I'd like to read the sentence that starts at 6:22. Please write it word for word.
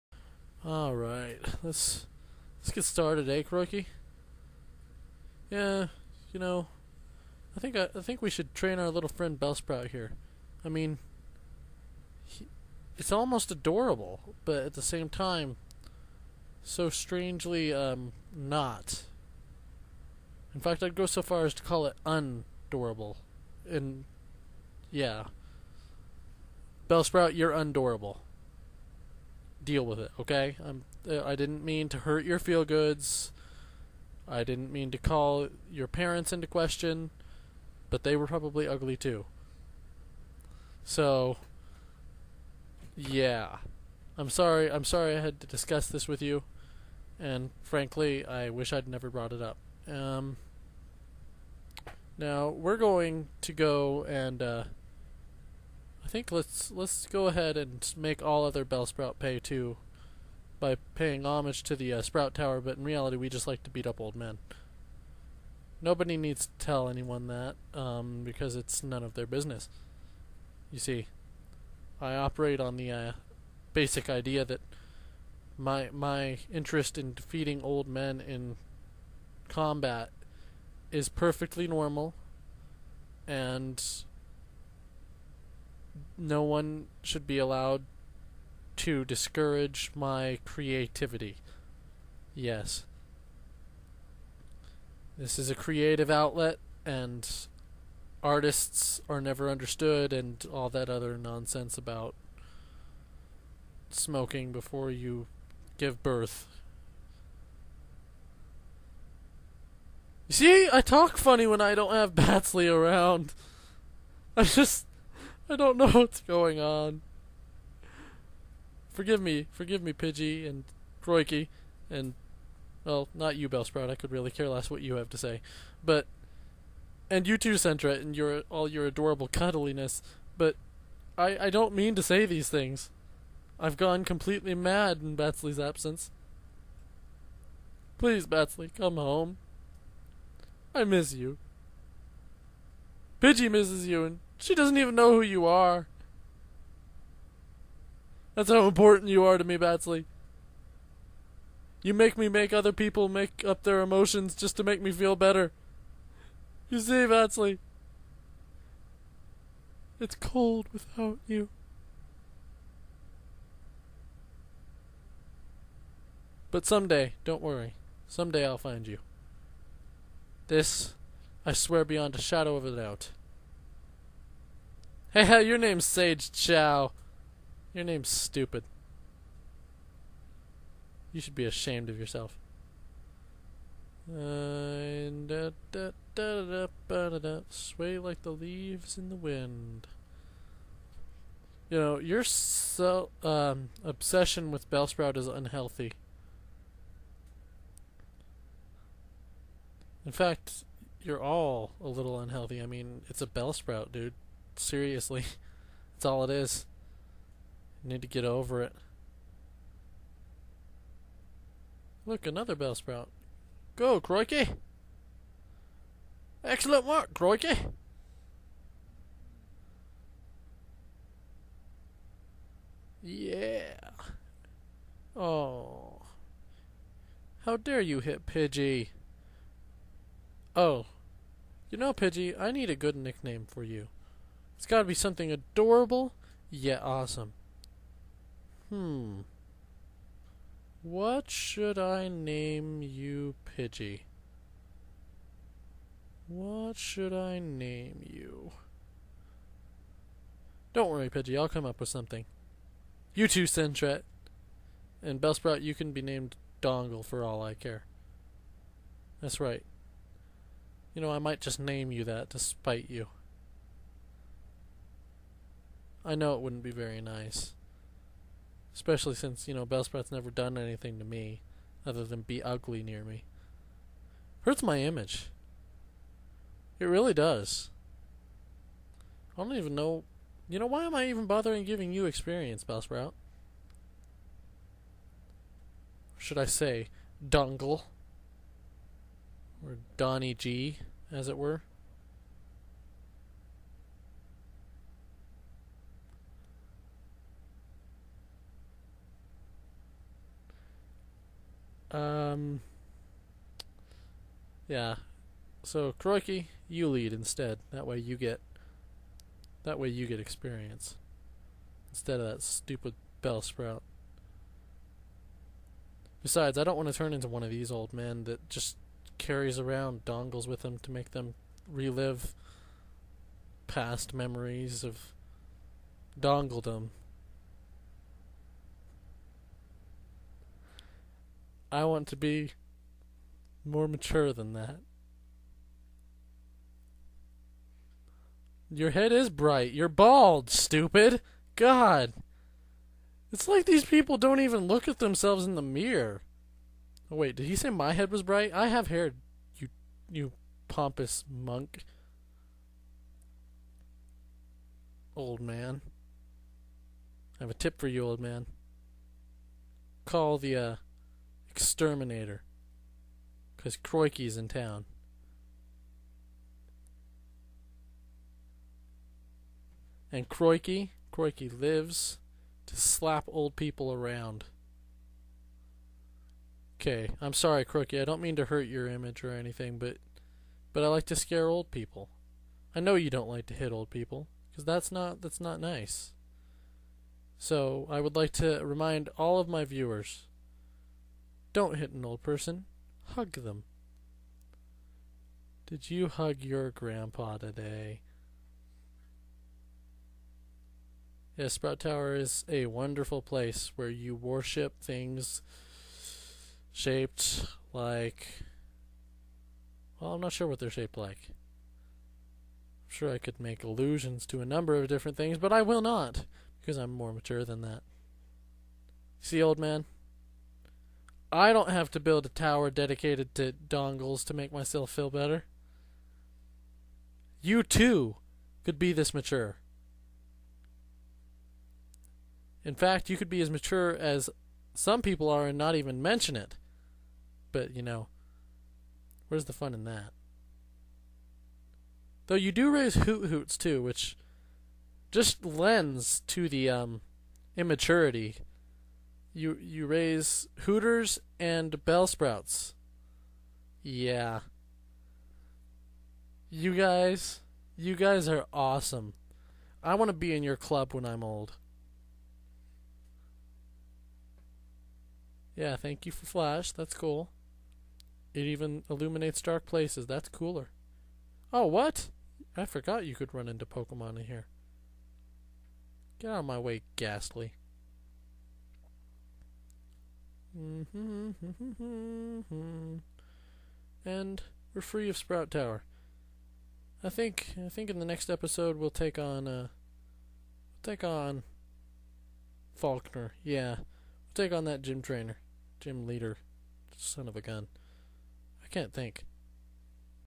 I know you don't like to hit old people, because that's not that's not nice.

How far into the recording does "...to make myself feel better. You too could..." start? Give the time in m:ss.
7:04.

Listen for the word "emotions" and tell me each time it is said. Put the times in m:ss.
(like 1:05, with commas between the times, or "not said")
2:33.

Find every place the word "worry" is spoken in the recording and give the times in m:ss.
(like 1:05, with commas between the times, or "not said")
2:47, 4:10.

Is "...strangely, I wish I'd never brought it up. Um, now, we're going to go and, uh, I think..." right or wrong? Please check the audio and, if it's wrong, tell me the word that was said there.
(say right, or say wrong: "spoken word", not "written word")
wrong: "frankly", not "strangely".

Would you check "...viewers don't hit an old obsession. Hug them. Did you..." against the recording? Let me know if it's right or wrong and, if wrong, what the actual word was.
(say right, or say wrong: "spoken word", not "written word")
wrong: "person", not "obsession".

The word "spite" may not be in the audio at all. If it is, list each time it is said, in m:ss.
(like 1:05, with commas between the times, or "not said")
4:22.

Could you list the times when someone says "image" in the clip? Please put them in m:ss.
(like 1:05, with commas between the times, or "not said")
4:34, 6:18.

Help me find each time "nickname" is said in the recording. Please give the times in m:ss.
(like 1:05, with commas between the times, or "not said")
3:52.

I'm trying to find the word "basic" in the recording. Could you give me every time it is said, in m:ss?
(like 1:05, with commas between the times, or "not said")
1:13.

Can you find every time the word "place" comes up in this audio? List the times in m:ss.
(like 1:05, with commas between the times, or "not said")
6:43, 7:49.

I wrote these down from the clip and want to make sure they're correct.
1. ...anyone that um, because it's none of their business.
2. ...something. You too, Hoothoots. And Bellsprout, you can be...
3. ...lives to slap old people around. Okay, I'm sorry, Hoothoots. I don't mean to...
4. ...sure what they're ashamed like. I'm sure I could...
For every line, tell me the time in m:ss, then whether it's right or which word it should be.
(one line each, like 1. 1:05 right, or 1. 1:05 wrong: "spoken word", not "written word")
1. 1:06 right
2. 4:11 wrong: "Sentret", not "Hoothoots"
3. 6:11 wrong: "Croiky", not "Hoothoots"
4. 6:50 wrong: "shaped", not "ashamed".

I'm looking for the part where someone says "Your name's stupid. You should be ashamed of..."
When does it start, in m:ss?
2:57.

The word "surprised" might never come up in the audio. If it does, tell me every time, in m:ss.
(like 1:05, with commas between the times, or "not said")
not said.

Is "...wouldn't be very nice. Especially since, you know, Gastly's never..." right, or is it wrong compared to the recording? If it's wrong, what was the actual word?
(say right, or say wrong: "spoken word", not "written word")
wrong: "Bellsprout", not "Gastly".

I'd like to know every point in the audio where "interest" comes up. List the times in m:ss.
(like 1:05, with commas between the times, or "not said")
1:16.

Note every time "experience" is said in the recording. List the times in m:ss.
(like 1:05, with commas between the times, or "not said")
4:42, 5:10.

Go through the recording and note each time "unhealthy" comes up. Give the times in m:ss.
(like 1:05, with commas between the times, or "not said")
3:15, 3:22.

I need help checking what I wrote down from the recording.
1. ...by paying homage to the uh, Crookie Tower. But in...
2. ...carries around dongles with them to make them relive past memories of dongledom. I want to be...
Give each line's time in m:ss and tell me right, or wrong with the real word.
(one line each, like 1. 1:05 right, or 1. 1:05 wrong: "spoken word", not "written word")
1. 1:00 wrong: "Sprout", not "Crookie"
2. 5:19 right.